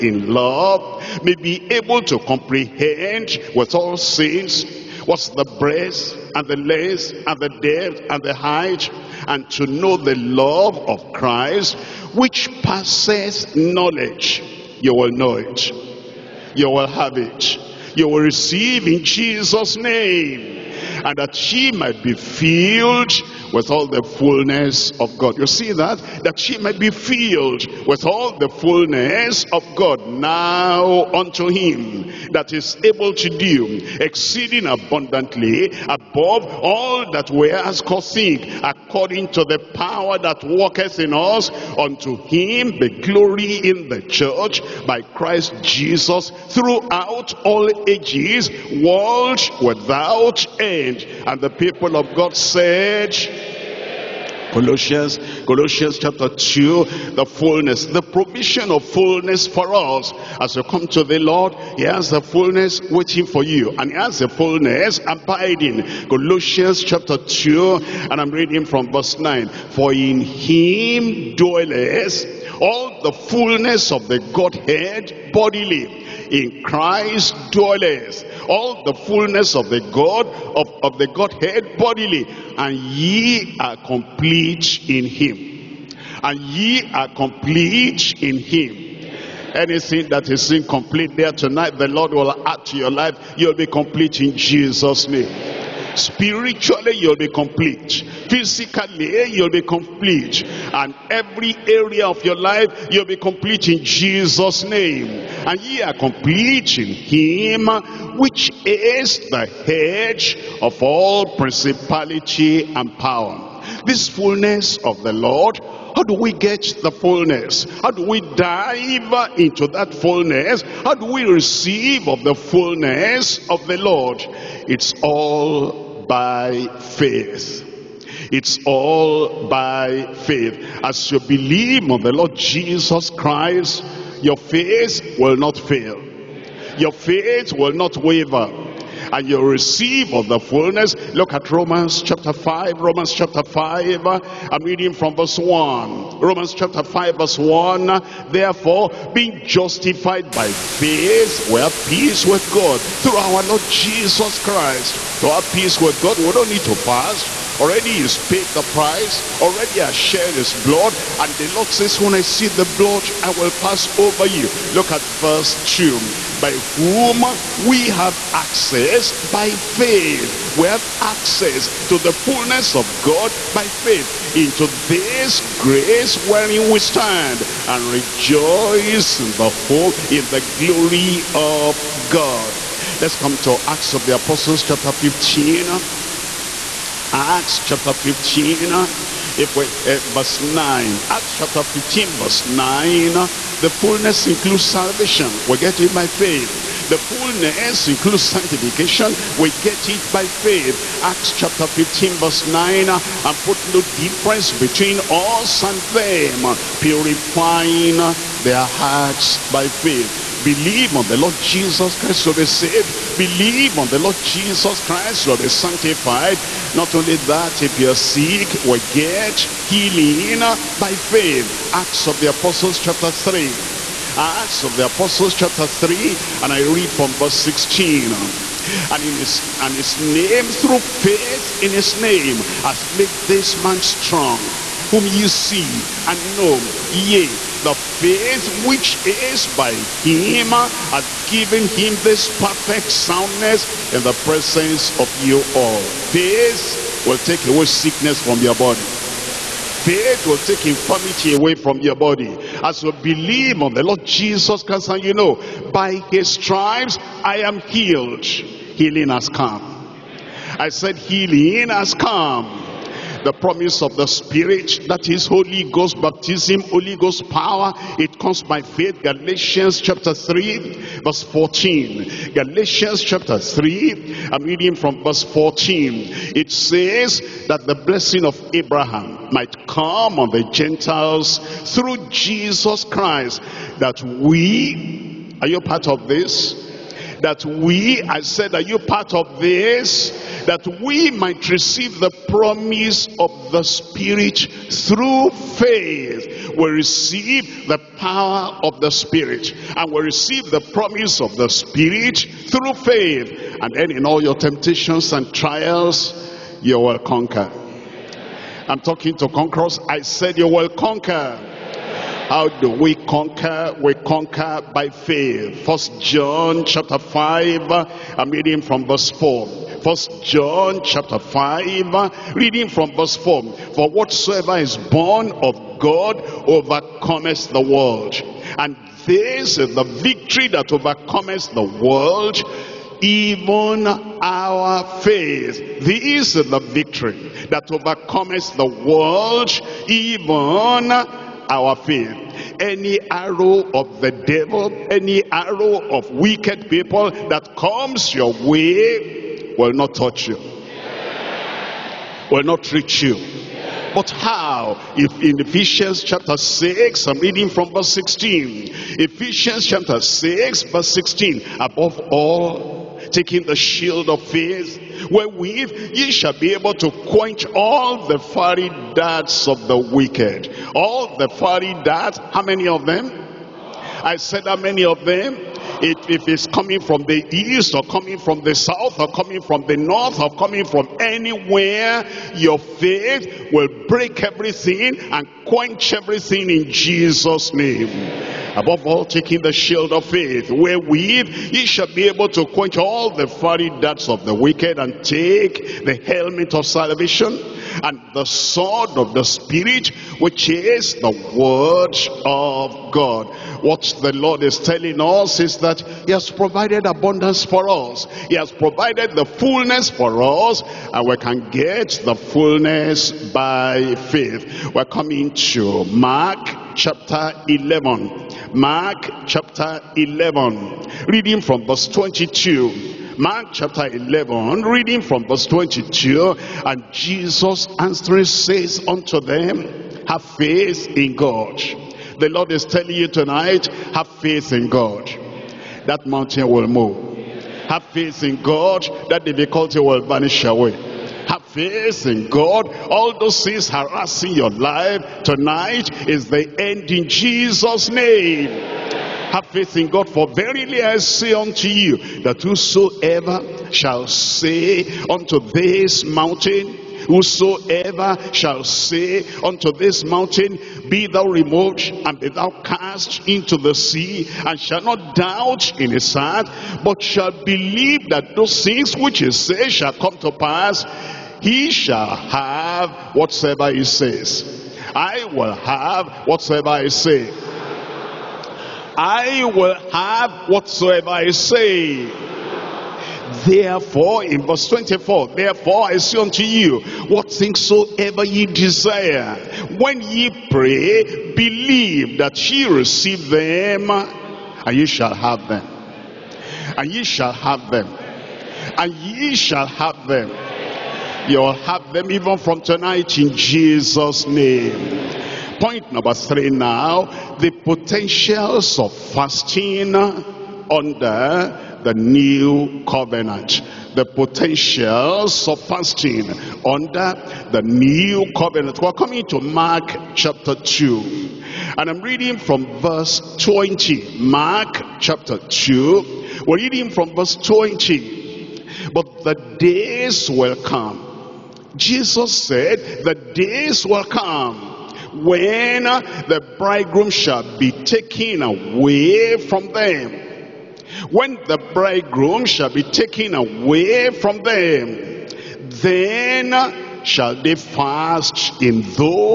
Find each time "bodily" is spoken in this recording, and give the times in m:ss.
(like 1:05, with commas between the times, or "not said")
1:15, 1:21.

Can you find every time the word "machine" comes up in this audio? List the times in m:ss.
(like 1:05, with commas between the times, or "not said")
not said.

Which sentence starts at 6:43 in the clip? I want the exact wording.
What the Lord is telling us is that that he has provided abundance for us.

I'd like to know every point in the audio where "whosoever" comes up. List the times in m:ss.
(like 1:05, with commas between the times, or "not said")
7:32, 7:37.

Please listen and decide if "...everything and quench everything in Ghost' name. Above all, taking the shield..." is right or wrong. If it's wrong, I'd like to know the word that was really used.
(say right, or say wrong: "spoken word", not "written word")
wrong: "Jesus", not "Ghost".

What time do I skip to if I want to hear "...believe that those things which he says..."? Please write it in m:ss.
7:47.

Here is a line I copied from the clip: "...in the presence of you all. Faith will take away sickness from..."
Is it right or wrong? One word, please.
right.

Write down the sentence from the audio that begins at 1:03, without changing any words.
And he has the fullness abiding.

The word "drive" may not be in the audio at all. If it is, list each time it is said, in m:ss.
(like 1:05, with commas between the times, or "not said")
not said.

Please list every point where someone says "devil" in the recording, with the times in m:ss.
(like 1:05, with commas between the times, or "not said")
5:44.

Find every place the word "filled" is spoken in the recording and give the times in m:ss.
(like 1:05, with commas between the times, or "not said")
0:22, 0:26.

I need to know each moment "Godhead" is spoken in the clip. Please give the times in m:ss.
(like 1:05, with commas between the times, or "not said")
1:14, 1:21.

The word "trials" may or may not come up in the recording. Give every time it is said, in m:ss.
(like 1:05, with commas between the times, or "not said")
5:05.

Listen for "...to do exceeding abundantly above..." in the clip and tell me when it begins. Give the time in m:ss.
0:33.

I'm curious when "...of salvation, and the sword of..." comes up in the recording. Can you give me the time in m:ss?
6:36.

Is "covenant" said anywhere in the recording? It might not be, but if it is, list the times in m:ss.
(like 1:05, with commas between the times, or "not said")
8:32, 8:38.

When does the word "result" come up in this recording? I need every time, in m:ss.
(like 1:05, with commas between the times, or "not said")
not said.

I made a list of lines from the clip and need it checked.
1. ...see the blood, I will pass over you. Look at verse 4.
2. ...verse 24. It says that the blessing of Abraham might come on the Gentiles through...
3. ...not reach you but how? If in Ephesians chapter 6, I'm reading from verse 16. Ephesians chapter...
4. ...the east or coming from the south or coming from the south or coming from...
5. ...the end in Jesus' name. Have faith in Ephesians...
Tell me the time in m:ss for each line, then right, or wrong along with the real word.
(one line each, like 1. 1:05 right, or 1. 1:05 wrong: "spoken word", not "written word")
1. 2:42 wrong: "2", not "4"
2. 4:35 wrong: "14", not "24"
3. 5:52 right
4. 6:17 wrong: "north", not "south"
5. 7:26 wrong: "God", not "Ephesians".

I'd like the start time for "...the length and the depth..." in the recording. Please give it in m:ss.
0:06.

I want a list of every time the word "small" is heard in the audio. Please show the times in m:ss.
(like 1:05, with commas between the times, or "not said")
not said.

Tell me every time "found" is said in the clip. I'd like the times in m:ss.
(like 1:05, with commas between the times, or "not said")
not said.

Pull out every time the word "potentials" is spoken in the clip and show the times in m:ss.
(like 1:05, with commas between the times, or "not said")
8:27, 8:34.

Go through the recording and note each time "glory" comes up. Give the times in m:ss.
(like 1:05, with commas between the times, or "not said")
0:43, 3:00.